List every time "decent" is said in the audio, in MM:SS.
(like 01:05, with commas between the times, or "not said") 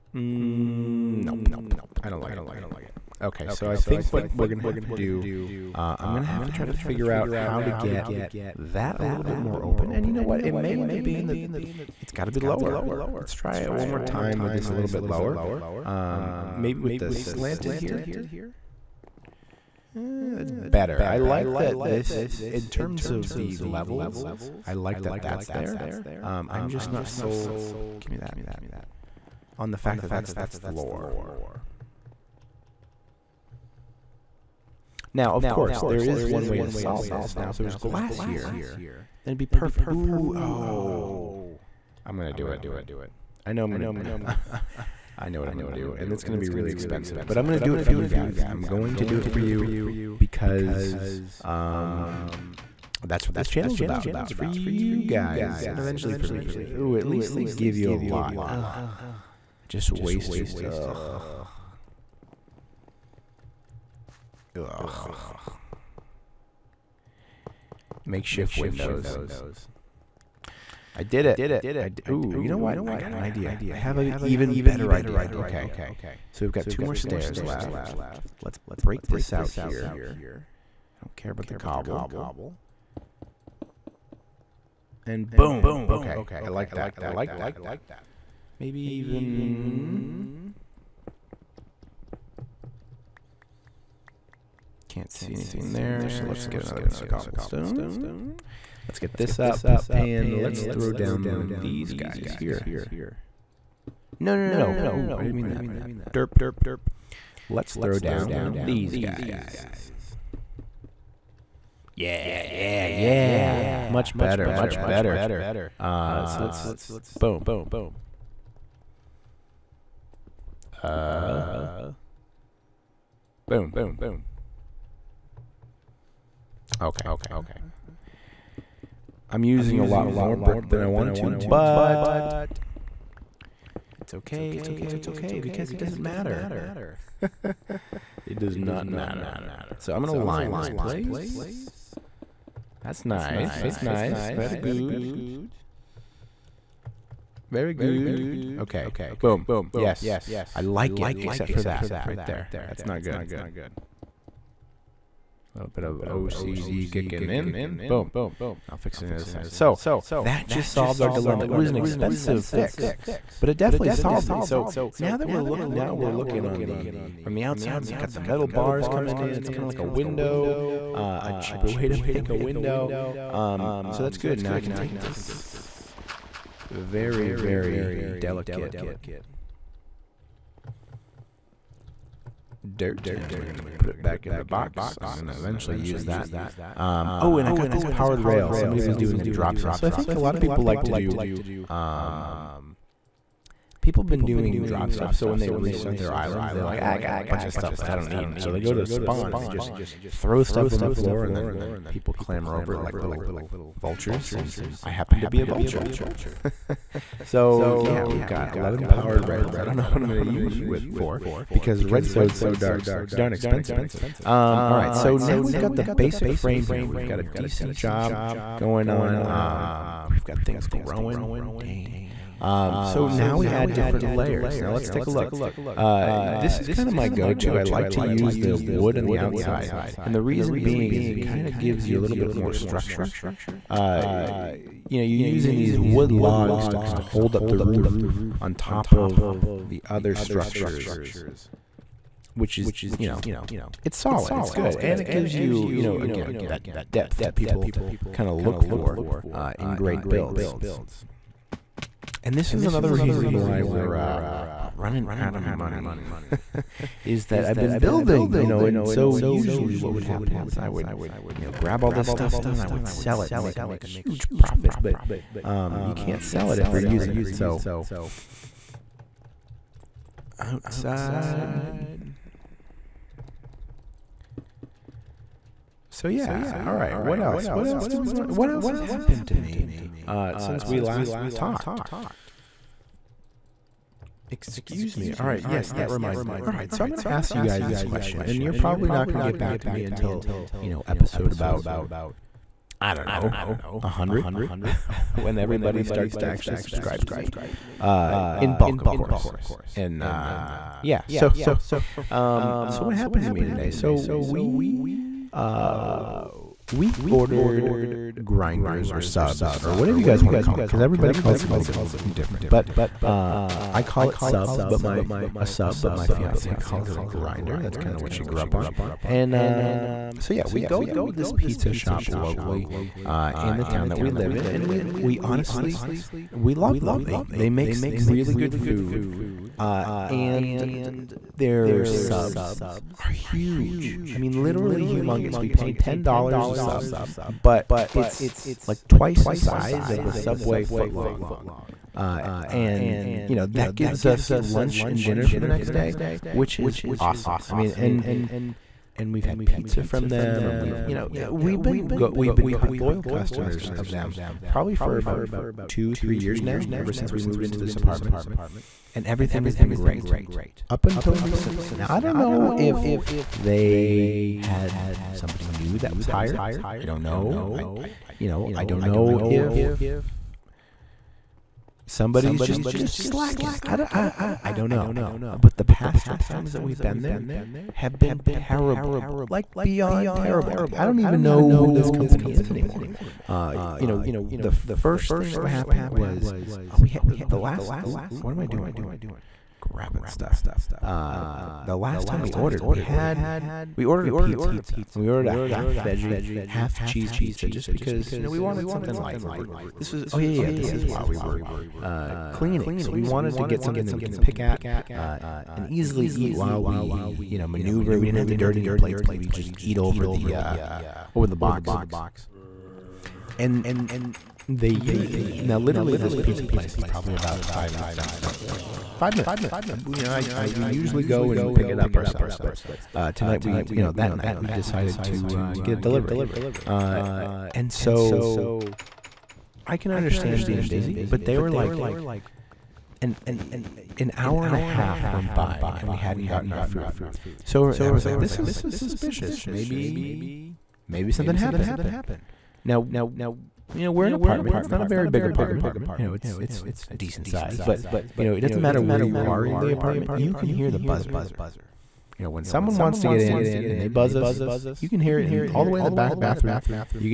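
03:37, 07:26.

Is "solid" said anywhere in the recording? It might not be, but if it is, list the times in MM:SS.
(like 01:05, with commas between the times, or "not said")
04:03.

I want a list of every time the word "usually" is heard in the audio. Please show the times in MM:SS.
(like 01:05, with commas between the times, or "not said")
04:19, 07:00.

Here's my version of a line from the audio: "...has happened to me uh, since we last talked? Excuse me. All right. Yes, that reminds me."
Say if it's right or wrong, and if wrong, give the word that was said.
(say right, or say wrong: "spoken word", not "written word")
right.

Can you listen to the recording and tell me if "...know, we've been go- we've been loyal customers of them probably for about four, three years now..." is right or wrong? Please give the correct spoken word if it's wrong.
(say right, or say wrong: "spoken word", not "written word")
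wrong: "two", not "four".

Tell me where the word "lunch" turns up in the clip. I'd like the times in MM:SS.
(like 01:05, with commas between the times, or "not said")
05:44.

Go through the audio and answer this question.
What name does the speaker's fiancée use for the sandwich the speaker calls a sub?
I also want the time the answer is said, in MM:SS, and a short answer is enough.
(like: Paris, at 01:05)
grinder, at 05:16.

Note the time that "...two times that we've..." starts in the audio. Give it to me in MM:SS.
06:16.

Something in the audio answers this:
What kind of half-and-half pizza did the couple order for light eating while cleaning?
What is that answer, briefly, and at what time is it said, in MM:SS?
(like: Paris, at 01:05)
half veggie, half cheese, at 06:35.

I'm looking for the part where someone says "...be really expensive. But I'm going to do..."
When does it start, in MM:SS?
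00:46.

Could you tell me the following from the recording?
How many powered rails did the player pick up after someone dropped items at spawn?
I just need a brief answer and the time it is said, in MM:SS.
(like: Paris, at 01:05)
11, at 03:28.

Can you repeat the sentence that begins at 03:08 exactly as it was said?
Somebody was doing a drop sale.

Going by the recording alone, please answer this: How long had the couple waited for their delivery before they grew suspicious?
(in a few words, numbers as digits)
an hour and a half.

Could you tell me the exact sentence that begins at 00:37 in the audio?
Now, if there was glass here, then it'd be perfect.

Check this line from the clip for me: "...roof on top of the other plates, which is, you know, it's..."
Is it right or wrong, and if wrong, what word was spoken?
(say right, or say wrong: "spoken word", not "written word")
wrong: "structures", not "plates".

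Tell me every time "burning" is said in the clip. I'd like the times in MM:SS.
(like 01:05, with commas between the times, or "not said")
not said.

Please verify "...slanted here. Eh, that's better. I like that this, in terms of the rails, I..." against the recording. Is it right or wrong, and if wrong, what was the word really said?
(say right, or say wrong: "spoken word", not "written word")
wrong: "levels", not "rails".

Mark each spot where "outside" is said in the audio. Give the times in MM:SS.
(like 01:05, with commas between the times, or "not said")
02:47, 03:49, 04:30.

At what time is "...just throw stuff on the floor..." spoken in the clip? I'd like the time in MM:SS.
03:19.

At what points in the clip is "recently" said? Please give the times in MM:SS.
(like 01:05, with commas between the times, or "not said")
06:01.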